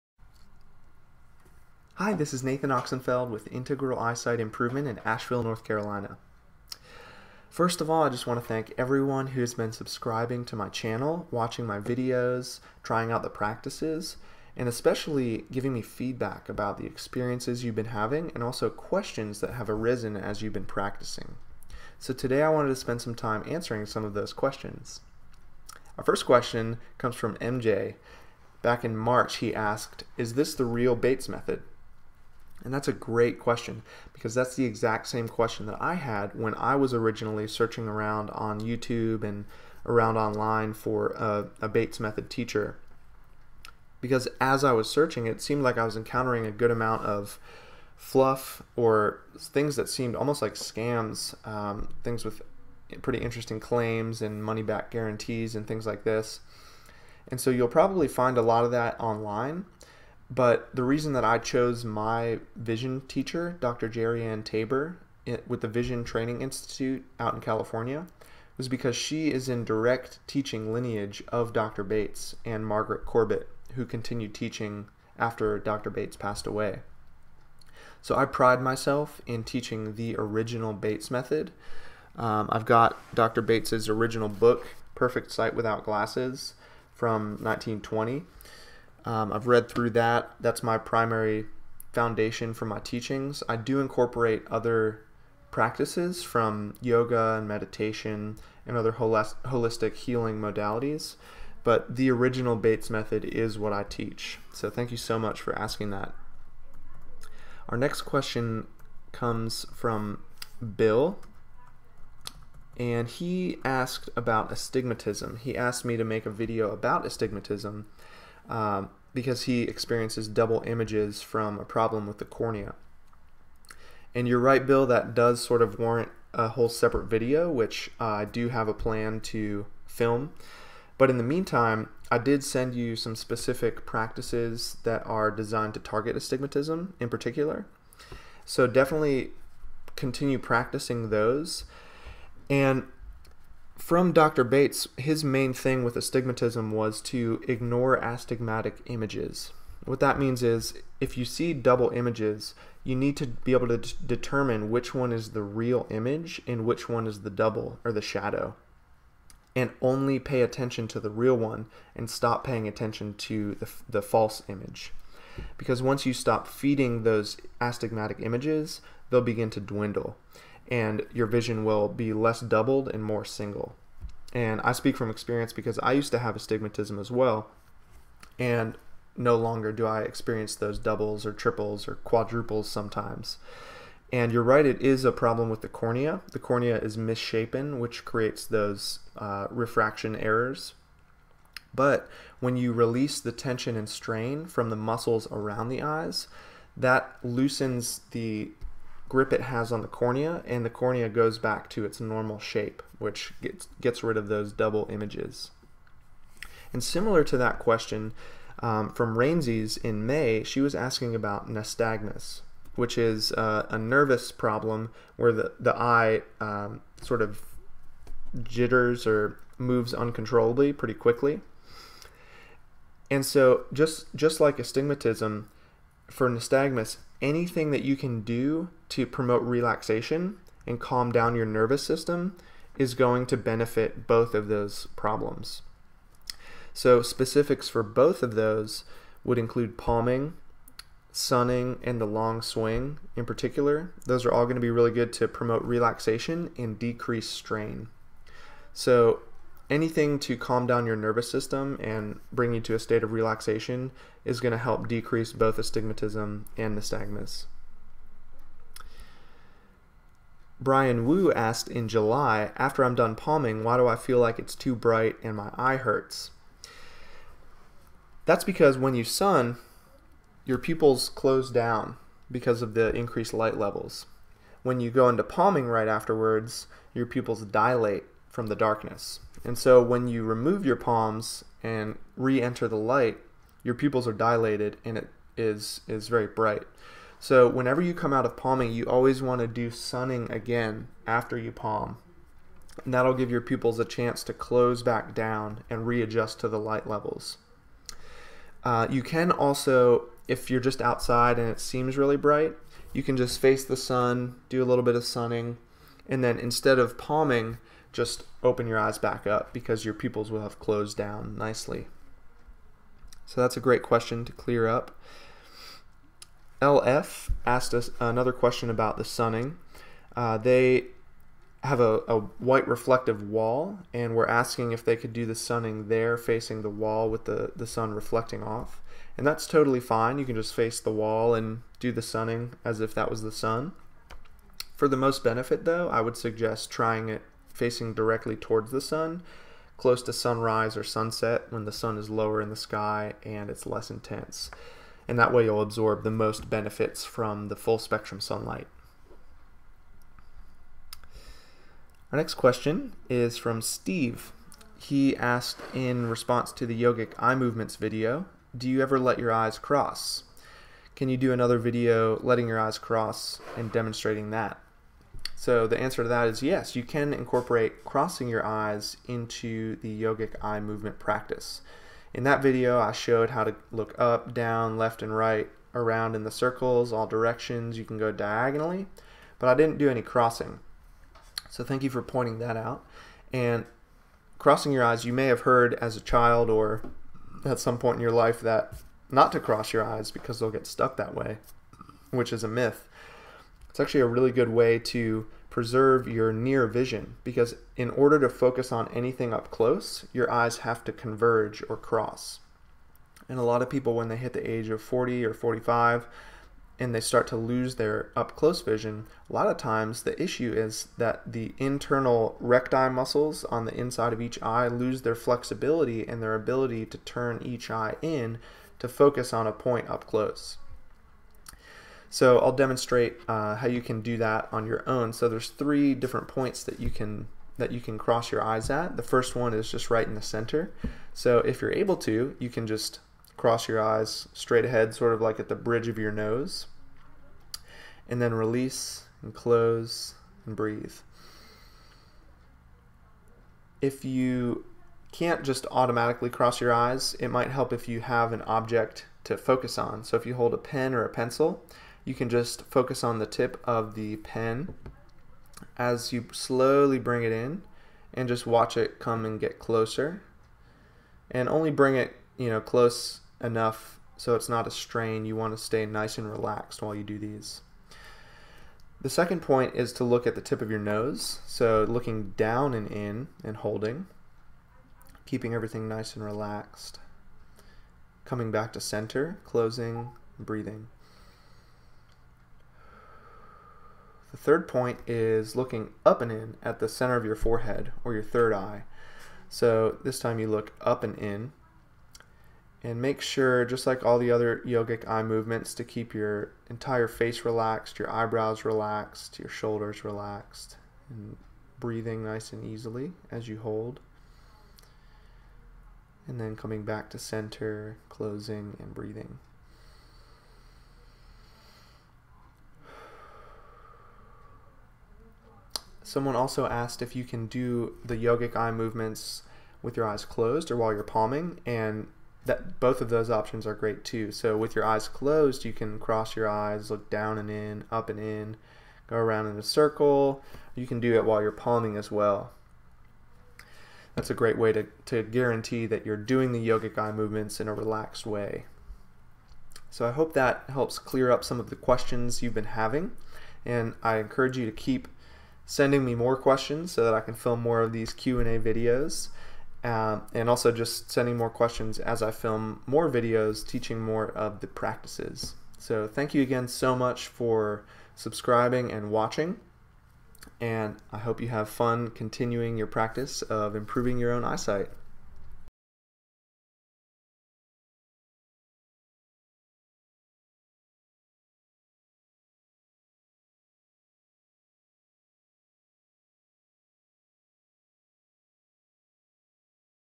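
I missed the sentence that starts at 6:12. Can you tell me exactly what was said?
In that video, I showed how to look up, down, left, and right, around in the circles, all directions.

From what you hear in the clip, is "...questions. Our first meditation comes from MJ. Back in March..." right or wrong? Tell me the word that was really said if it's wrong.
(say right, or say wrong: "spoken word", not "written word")
wrong: "question", not "meditation".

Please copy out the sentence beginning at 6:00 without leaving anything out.
Can you do another video letting your eyes cross and demonstrating that?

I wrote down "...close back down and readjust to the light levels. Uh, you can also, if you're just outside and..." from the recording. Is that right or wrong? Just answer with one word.
right.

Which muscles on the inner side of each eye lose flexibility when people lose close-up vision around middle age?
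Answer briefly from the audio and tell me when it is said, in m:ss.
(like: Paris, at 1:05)
internal recti muscles, at 6:51.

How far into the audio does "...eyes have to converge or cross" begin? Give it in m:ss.
6:40.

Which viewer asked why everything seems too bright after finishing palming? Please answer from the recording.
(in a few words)
Brian Wu.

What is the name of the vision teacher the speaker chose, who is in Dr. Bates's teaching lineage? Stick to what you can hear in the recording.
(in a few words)
Dr. Jerriann Taber.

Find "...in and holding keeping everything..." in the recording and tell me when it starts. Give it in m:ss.
7:52.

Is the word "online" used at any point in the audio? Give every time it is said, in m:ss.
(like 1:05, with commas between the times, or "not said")
0:40, 0:58.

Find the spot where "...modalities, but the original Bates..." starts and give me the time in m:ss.
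1:40.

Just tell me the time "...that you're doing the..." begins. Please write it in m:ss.
8:55.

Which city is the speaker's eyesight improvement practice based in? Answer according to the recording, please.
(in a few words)
Asheville.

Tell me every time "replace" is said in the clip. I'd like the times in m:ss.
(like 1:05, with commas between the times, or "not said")
not said.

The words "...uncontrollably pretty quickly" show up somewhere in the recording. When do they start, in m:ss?
3:39.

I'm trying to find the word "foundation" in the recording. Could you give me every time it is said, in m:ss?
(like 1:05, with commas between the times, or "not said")
1:31.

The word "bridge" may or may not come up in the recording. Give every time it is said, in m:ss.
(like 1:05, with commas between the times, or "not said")
7:15.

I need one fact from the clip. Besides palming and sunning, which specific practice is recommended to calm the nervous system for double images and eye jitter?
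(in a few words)
the long swing.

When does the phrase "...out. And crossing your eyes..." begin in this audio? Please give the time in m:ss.
6:22.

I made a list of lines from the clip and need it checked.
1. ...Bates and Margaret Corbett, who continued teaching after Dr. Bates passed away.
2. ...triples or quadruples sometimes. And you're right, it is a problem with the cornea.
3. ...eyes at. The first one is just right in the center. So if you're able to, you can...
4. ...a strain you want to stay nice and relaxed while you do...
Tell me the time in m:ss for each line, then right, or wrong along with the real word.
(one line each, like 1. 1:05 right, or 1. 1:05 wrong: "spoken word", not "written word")
1. 1:11 right
2. 3:01 right
3. 7:08 right
4. 7:44 right.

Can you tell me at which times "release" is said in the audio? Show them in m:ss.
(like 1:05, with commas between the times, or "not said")
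3:12, 7:18.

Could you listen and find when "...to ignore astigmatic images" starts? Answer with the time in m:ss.
2:27.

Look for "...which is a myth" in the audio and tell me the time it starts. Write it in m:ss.
6:32.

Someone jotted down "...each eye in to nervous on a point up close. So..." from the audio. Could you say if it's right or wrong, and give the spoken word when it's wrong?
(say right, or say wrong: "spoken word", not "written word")
wrong: "focus", not "nervous".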